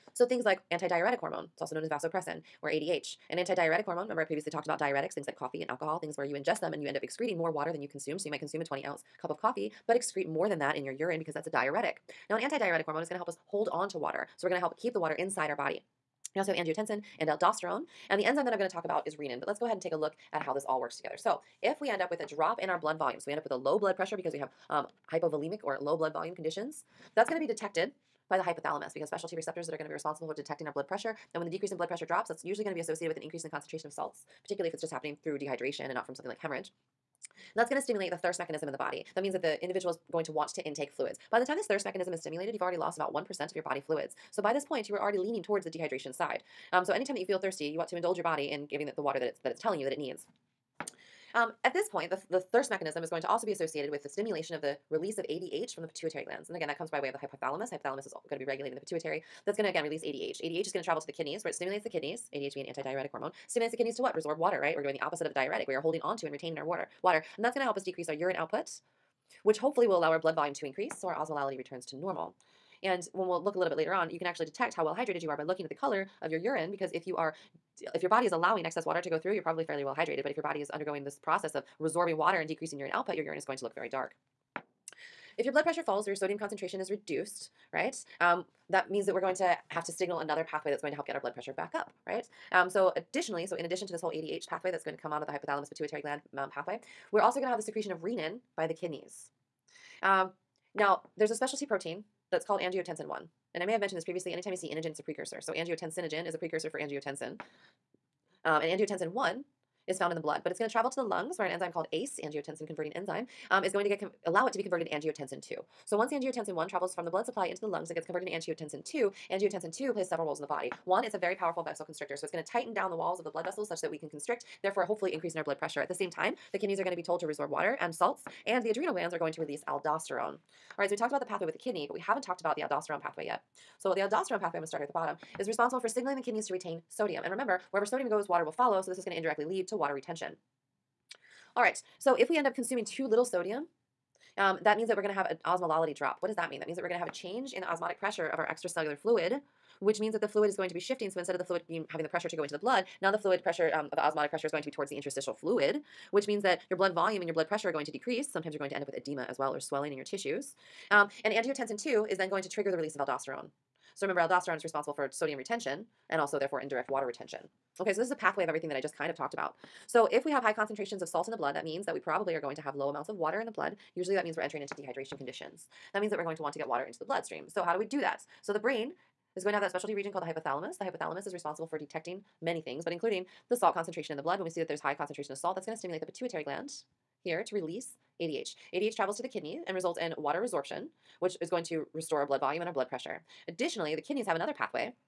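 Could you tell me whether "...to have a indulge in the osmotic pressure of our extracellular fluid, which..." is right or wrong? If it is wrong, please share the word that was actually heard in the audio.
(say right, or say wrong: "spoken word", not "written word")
wrong: "change", not "indulge".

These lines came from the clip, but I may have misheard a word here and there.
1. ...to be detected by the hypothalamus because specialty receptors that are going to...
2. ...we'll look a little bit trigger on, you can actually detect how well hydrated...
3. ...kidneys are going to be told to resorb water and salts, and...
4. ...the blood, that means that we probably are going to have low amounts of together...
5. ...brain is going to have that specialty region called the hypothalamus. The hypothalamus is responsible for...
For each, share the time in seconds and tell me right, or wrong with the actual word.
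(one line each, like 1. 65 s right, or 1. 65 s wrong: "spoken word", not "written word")
1. 27 s right
2. 73 s wrong: "later", not "trigger"
3. 126 s right
4. 171 s wrong: "water", not "together"
5. 178 s right.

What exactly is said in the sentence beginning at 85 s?
If your blood pressure falls or your sodium concentration is reduced, right?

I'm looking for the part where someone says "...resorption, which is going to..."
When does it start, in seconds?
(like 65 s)
190 s.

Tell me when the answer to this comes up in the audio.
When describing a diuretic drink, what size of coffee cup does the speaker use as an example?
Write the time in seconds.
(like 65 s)
8 s.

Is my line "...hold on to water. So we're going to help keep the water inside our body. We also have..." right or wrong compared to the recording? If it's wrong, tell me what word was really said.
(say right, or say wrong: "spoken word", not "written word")
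right.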